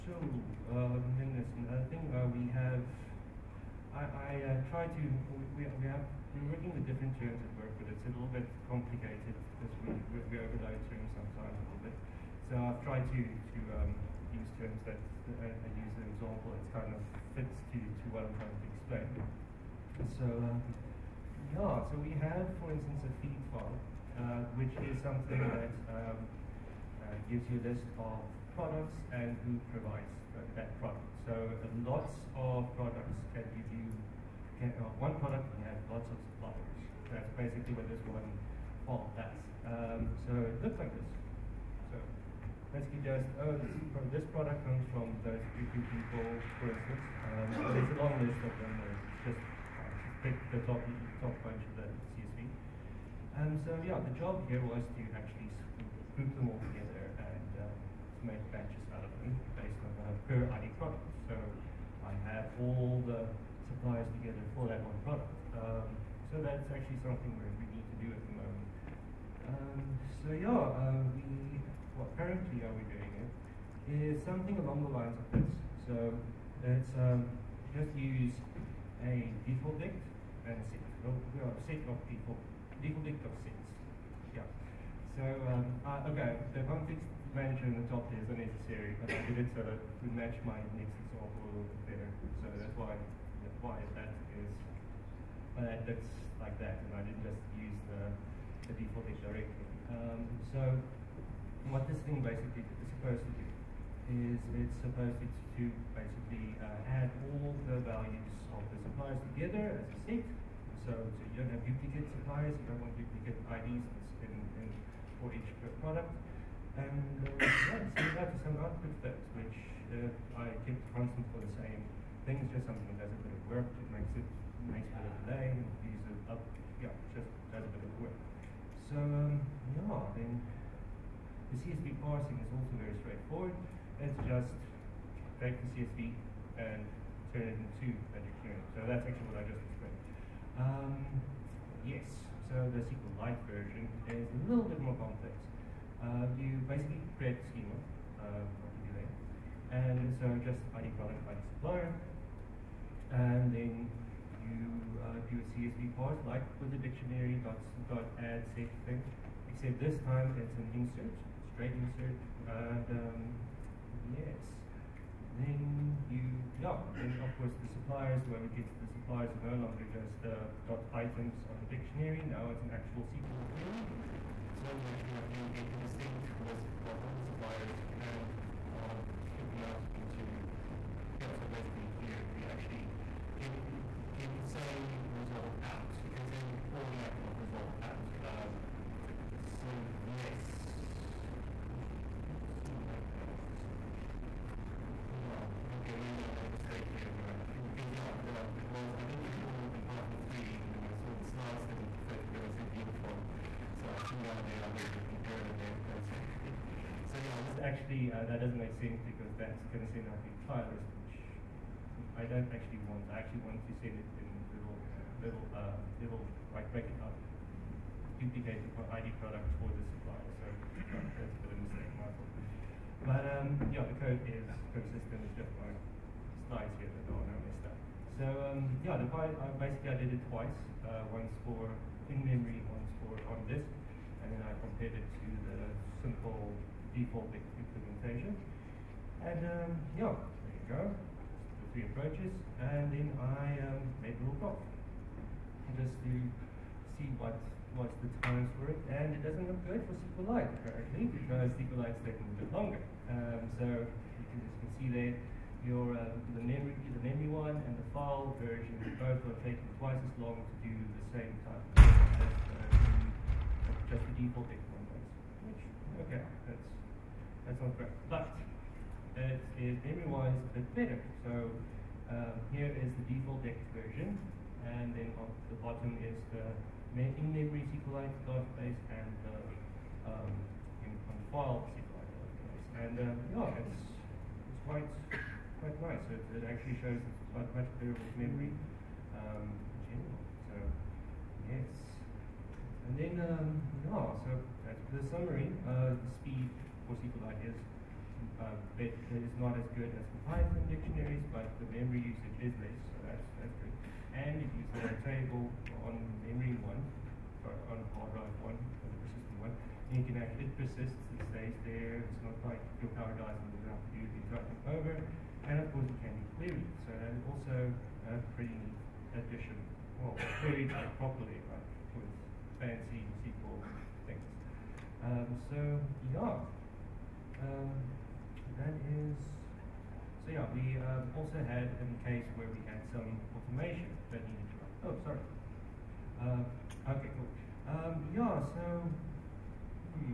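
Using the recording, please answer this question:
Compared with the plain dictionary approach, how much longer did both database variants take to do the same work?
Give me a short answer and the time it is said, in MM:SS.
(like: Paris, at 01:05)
Twice as long, at 04:19.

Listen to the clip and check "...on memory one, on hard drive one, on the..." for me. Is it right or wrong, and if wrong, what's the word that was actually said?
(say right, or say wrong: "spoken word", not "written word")
right.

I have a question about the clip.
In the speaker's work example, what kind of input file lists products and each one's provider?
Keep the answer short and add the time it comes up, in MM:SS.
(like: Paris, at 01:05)
Feed file, at 00:23.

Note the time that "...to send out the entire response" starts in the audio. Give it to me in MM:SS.
03:29.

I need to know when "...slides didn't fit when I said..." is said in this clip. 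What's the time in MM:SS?
03:21.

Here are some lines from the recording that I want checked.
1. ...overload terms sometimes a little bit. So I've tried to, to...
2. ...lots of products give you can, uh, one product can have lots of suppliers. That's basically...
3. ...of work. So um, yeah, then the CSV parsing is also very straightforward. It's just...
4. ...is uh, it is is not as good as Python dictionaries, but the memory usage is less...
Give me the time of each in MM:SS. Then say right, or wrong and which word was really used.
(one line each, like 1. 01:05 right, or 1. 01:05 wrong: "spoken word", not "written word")
1. 00:10 right
2. 00:31 right
3. 02:07 right
4. 04:57 right.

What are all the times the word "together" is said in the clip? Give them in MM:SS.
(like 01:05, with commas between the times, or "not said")
00:56, 01:04, 01:49.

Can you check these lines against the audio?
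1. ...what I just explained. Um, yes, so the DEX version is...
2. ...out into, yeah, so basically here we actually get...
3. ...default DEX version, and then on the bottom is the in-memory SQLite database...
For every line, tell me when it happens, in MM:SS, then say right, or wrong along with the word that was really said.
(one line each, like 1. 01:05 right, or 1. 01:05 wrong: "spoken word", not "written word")
1. 02:19 wrong: "SQLite", not "DEX"
2. 02:59 right
3. 04:33 right.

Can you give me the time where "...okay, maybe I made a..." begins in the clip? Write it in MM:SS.
03:15.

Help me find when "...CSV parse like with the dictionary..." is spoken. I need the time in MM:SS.
02:35.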